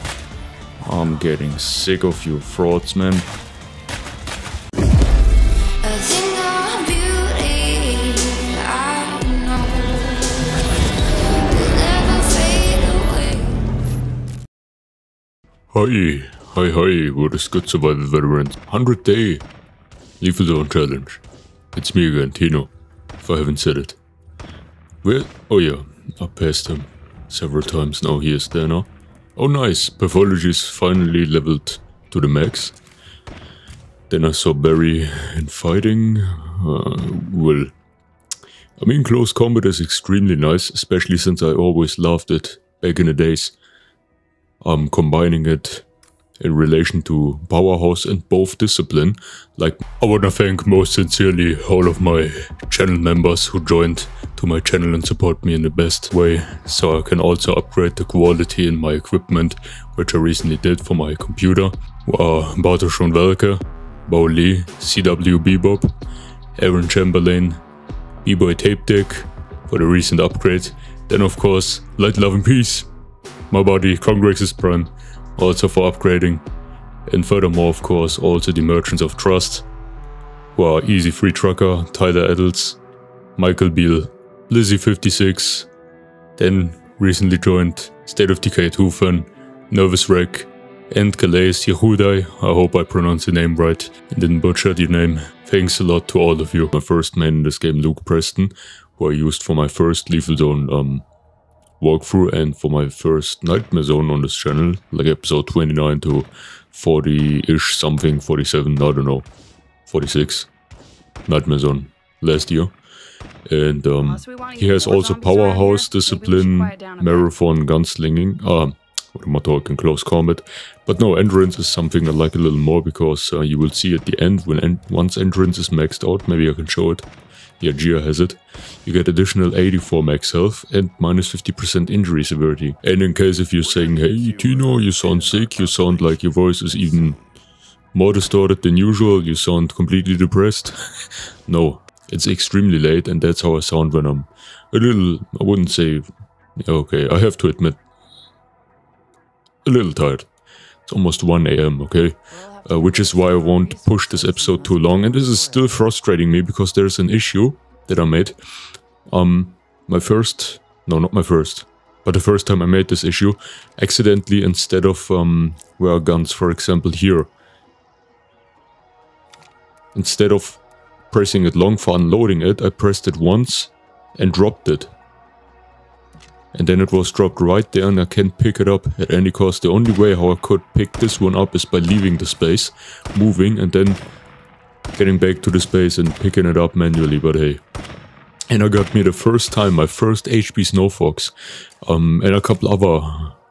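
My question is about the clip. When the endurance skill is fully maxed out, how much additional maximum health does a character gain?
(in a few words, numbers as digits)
84.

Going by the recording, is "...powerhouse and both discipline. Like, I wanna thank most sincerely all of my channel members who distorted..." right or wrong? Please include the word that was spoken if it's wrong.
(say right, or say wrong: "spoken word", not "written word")
wrong: "joined", not "distorted".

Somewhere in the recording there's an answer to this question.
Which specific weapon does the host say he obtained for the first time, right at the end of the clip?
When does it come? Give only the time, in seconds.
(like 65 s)
190 s.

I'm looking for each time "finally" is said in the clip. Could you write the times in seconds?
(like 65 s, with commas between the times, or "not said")
30 s.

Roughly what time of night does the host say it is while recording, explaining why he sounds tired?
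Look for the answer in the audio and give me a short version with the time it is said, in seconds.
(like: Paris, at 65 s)
1 a.m., at 151 s.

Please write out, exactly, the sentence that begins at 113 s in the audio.
And um, he has also powerhouse discipline, marathon, gunslinging.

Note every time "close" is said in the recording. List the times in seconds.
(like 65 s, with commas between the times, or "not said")
39 s, 119 s.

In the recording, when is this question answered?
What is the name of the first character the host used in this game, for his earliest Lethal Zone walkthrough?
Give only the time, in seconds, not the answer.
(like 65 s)
97 s.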